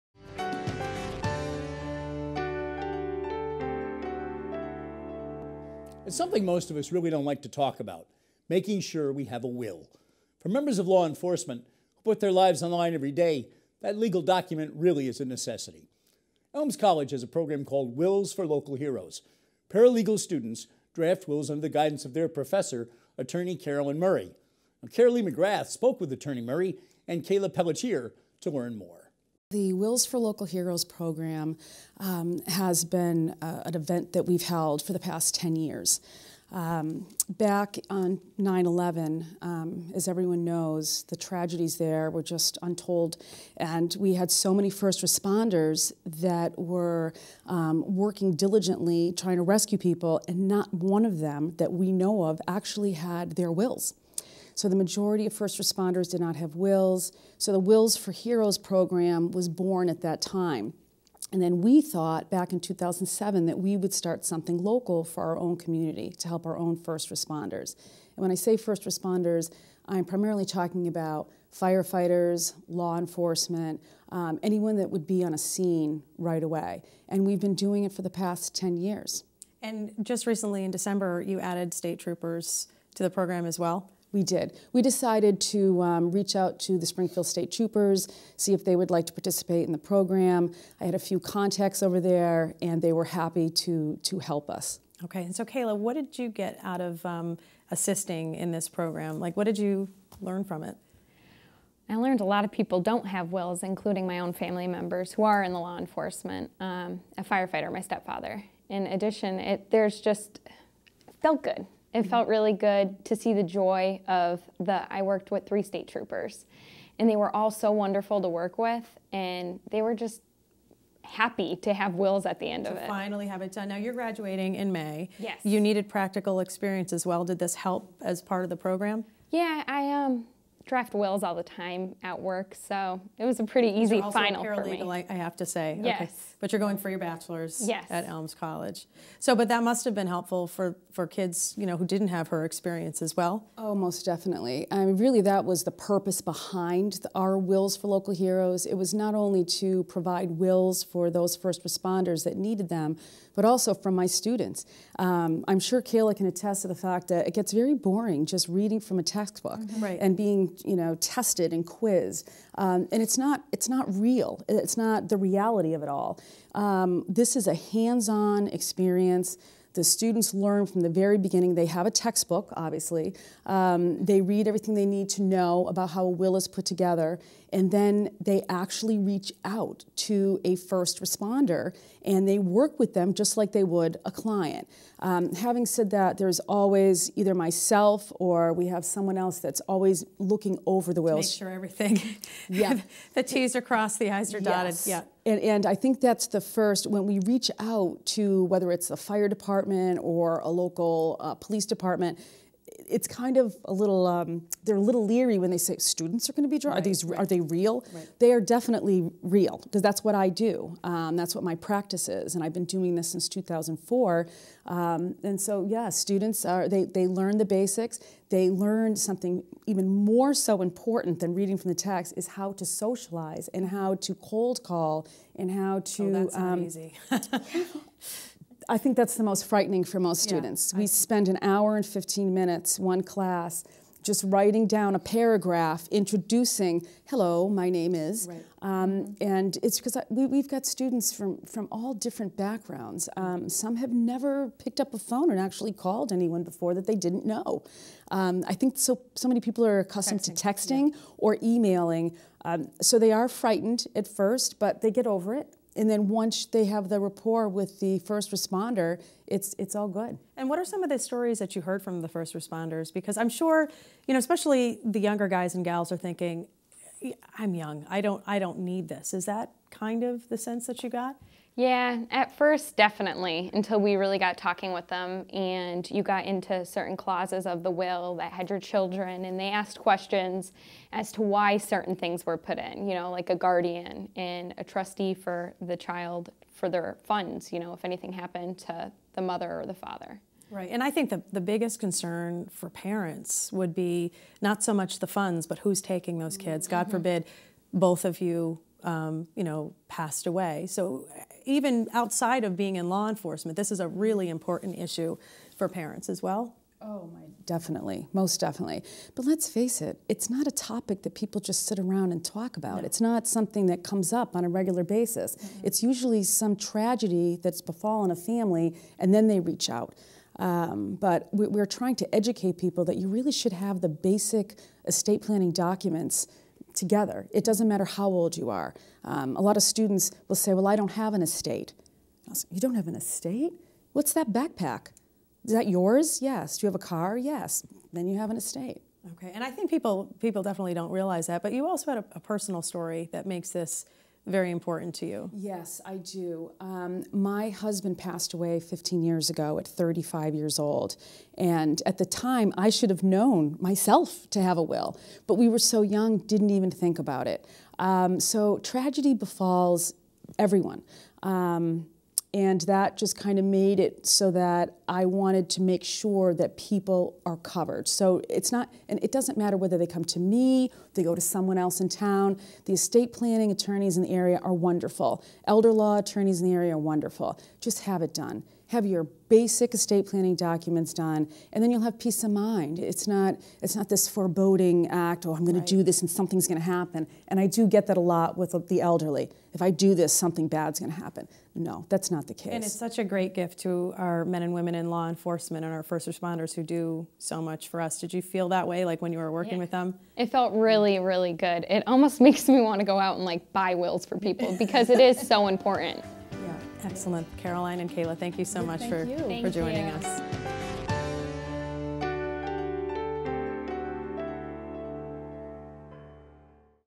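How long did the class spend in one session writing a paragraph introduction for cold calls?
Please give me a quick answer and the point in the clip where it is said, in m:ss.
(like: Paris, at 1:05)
1 hour and 15 minutes, at 3:51.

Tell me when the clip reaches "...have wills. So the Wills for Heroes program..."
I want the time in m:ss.
0:56.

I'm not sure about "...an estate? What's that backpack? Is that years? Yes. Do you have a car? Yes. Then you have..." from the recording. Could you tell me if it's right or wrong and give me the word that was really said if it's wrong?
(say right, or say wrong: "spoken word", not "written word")
wrong: "yours", not "years".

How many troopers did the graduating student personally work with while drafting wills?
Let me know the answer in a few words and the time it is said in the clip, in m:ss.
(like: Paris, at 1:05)
3, at 1:55.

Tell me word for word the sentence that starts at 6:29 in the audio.
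If I do this, something bad's gonna happen.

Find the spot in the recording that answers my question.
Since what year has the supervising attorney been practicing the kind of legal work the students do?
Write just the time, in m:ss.
3:33.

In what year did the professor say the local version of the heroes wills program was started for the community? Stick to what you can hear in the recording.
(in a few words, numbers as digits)
2007.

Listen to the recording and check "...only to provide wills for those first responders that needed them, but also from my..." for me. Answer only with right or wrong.
right.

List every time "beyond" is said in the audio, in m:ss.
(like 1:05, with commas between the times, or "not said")
not said.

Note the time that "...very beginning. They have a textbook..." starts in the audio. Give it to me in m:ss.
2:50.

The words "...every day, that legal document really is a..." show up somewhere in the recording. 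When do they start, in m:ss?
0:12.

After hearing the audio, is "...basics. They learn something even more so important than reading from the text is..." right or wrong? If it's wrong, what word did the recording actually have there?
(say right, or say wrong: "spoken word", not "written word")
right.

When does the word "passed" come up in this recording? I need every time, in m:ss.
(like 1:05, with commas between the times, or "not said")
4:59, 5:47.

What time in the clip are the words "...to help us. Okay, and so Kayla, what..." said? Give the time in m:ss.
1:34.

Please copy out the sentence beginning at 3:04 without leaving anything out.
Um, having said that, there's always either myself or we have someone else that's always looking over the wheels.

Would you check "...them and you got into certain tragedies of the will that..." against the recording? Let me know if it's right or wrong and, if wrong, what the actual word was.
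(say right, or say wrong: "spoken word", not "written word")
wrong: "clauses", not "tragedies".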